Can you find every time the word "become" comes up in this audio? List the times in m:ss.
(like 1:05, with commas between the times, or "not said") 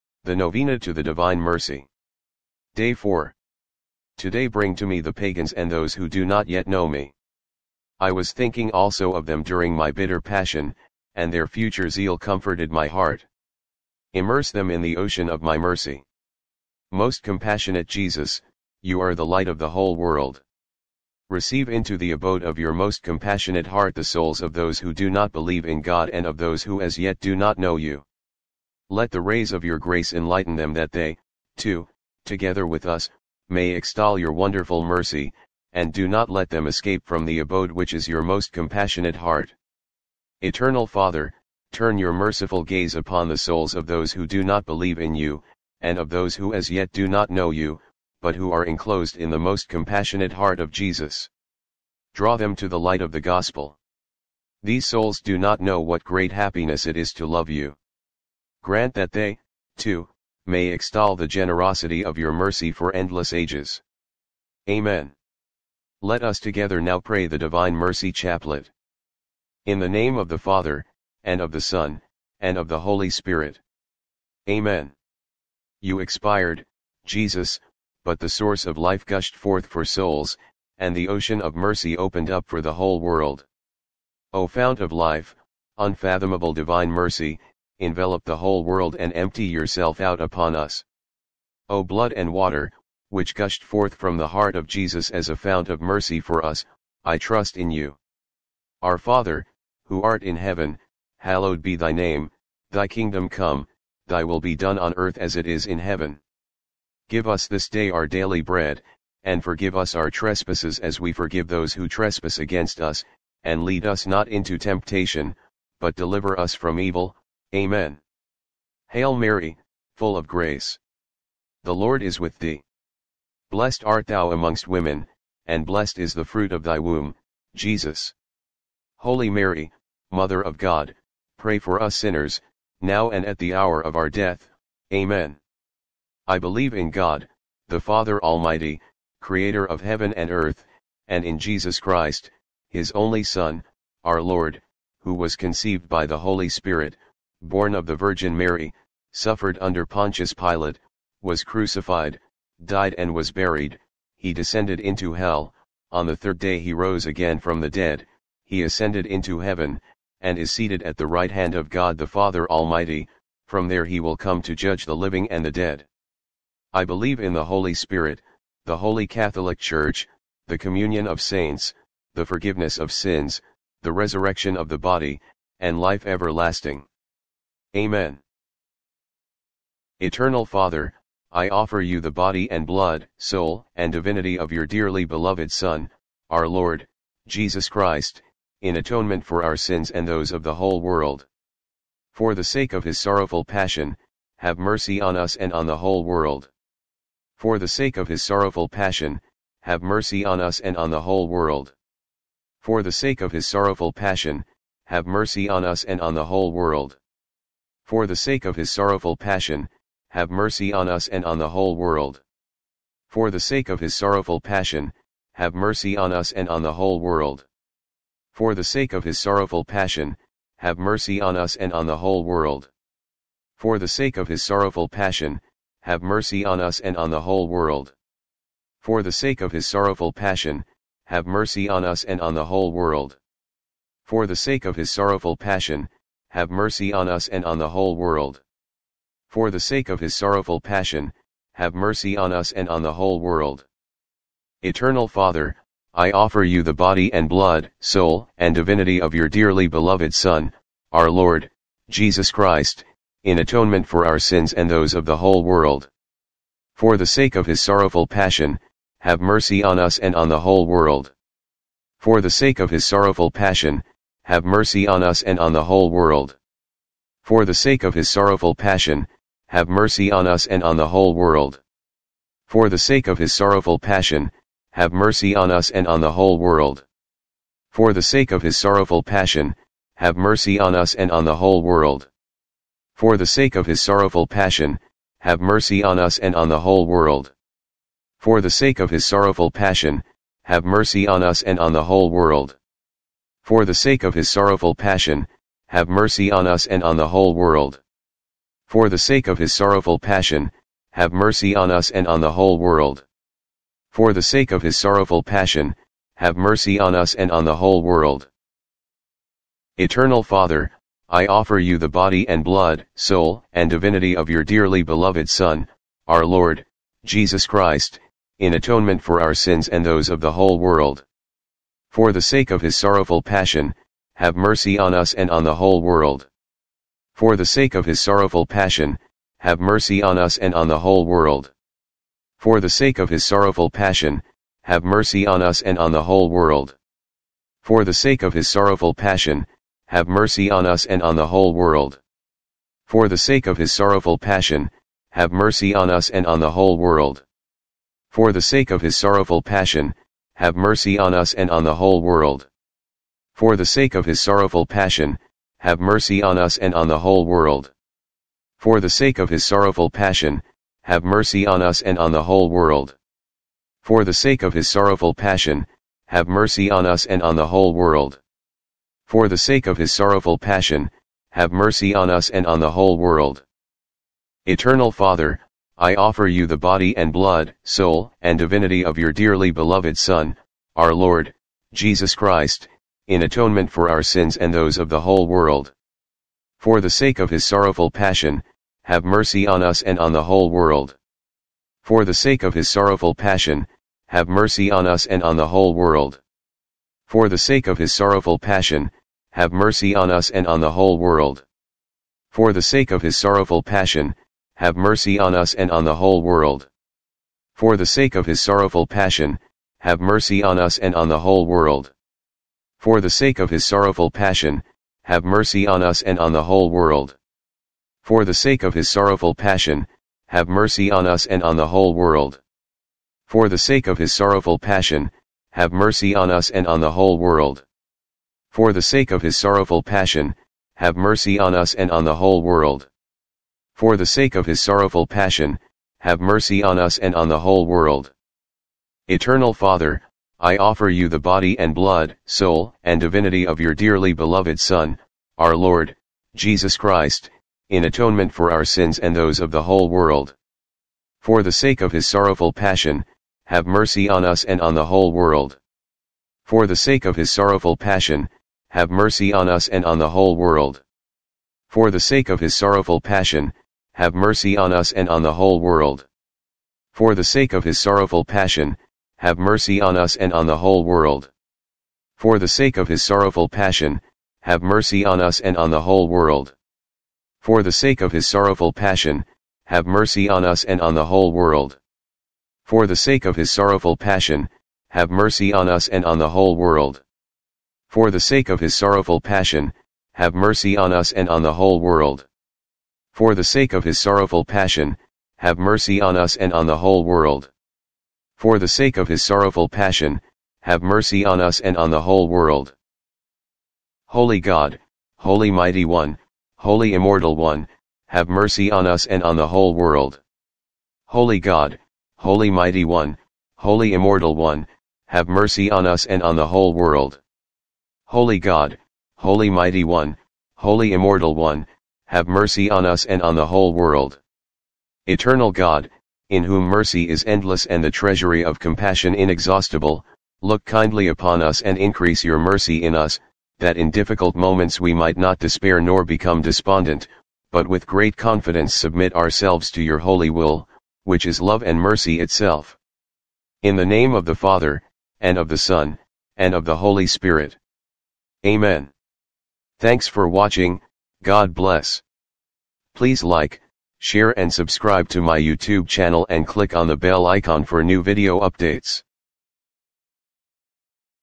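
8:56.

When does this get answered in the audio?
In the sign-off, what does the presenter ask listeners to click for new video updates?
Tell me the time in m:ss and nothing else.
9:16.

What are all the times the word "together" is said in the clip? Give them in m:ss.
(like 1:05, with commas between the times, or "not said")
0:32, 1:06.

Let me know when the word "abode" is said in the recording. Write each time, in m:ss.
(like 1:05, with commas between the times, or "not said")
0:22, 0:37.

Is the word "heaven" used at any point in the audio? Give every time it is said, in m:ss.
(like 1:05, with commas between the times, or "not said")
1:40, 1:45, 2:19, 2:39.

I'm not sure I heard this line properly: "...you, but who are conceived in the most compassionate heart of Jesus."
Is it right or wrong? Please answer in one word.
wrong.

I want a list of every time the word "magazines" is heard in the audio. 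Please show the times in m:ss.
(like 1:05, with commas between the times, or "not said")
not said.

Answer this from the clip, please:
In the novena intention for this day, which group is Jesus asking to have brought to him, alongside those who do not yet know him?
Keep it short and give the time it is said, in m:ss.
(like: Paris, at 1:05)
the pagans, at 0:05.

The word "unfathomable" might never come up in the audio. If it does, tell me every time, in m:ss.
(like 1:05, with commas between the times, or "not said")
1:25.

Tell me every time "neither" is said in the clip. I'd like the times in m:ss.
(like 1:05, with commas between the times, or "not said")
not said.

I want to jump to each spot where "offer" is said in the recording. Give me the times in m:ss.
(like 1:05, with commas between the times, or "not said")
3:01, 4:06, 5:11, 6:15, 7:20.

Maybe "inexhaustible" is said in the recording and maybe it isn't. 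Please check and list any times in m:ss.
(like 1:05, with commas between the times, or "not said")
8:49.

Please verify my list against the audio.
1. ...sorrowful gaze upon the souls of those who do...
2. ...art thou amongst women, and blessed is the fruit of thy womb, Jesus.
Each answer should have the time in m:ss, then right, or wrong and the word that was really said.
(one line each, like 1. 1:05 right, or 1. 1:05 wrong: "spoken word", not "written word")
1. 0:42 wrong: "merciful", not "sorrowful"
2. 2:03 right.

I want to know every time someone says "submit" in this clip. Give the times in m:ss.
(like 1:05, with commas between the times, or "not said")
8:58.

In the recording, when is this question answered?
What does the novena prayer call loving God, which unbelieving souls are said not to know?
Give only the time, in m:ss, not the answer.
0:56.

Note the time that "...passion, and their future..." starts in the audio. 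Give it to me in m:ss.
0:10.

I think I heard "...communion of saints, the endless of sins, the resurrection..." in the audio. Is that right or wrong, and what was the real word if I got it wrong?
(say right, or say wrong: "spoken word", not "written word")
wrong: "forgiveness", not "endless".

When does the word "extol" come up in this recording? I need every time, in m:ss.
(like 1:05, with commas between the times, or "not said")
0:33, 1:00.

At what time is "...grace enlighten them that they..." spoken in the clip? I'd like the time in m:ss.
0:29.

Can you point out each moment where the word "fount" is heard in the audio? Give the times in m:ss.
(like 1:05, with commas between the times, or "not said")
1:24, 1:35.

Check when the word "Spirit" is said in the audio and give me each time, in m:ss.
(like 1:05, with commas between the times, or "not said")
1:13, 2:26, 2:47, 9:07.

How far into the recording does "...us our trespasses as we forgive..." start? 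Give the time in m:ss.
1:49.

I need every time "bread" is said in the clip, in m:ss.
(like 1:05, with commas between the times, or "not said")
1:48.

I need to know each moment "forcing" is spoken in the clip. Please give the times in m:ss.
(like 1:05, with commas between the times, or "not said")
not said.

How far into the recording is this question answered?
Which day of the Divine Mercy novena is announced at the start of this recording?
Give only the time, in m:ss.
0:02.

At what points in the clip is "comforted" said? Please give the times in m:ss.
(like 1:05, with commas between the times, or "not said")
0:12.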